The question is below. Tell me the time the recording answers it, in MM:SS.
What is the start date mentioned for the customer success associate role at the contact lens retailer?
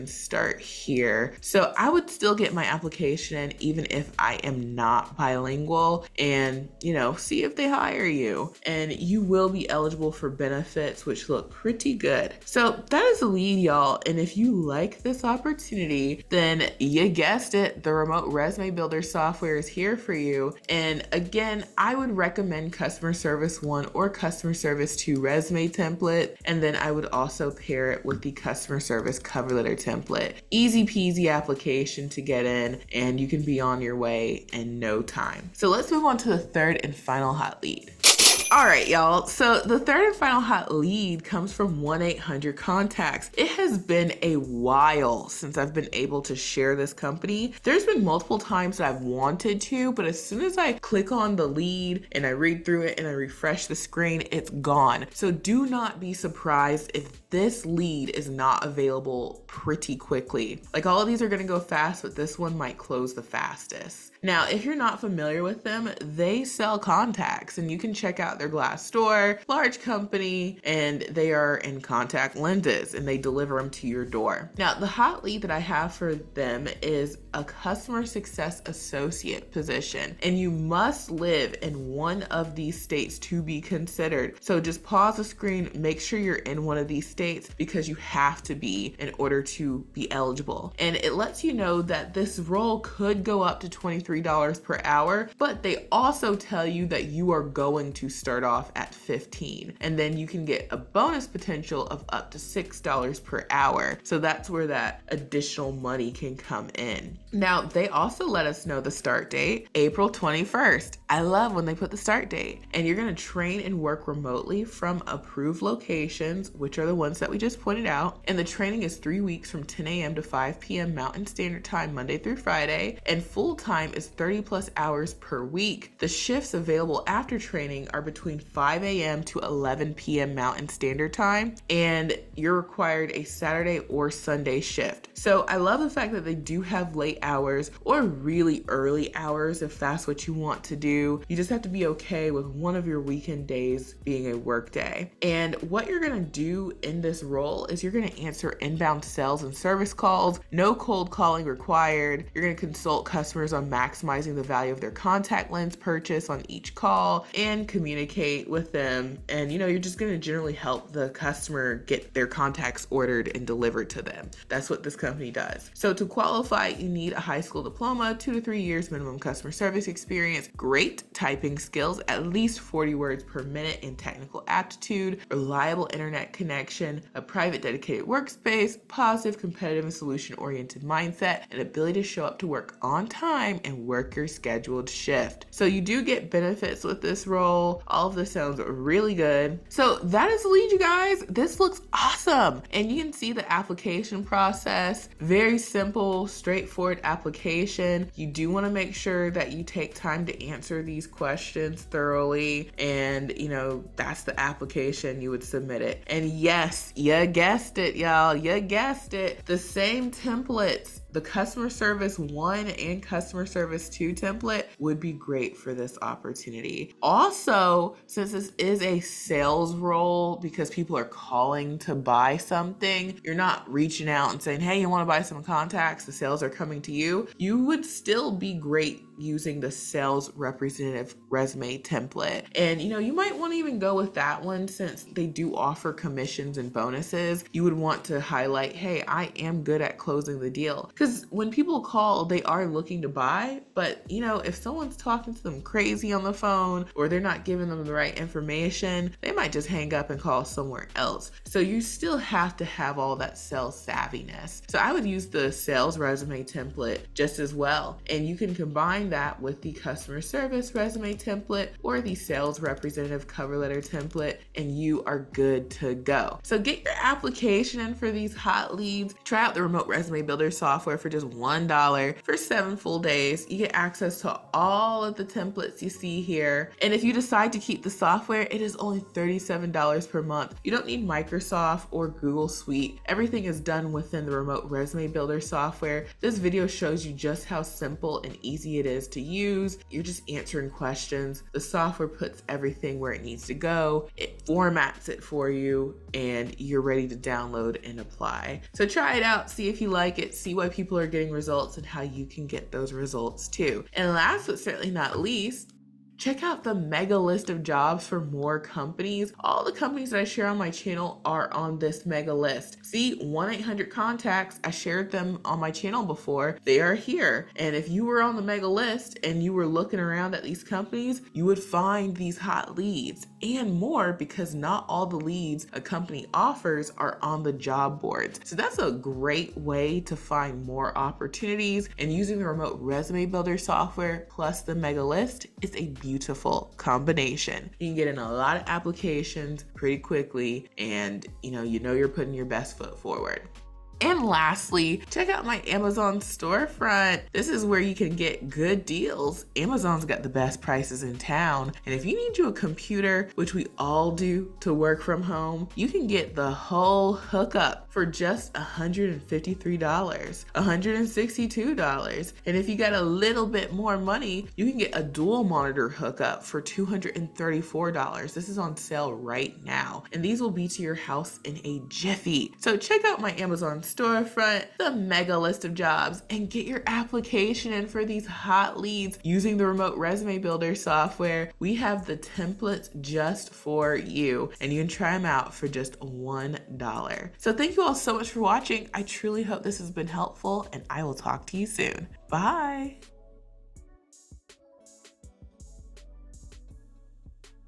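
01:49.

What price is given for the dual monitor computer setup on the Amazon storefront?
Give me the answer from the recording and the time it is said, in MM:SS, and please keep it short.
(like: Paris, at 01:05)
$234, at 06:06.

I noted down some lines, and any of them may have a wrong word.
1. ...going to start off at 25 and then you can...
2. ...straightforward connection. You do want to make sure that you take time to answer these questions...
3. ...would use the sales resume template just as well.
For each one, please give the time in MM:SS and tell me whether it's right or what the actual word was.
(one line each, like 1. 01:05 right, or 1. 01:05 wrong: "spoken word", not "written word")
1. 01:37 wrong: "15", not "25"
2. 03:16 wrong: "application", not "connection"
3. 04:14 right.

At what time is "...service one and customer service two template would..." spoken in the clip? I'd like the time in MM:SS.
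03:31.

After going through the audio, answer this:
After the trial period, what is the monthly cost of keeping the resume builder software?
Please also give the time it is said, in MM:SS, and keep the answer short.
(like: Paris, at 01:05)
$37, at 04:38.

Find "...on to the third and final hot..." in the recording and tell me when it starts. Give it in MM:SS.
00:36.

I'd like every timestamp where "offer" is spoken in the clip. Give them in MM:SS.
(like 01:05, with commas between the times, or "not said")
03:55, 05:26.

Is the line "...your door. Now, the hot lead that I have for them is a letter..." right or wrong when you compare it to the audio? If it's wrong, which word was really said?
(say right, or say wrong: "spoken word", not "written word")
wrong: "customer", not "letter".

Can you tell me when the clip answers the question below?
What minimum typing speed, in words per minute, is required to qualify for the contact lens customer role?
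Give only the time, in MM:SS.
02:52.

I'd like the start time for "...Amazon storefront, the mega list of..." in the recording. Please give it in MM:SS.
06:13.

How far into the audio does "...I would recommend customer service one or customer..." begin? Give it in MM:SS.
00:21.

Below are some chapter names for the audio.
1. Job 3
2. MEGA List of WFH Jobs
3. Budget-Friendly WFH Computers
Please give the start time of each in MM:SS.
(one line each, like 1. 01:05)
1. 00:38
2. 05:06
3. 05:44.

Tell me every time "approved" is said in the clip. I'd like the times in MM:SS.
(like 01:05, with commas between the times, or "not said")
01:55.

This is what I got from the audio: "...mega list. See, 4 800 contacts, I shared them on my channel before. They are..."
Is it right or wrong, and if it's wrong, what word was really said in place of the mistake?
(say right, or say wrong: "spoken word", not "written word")
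wrong: "1", not "4".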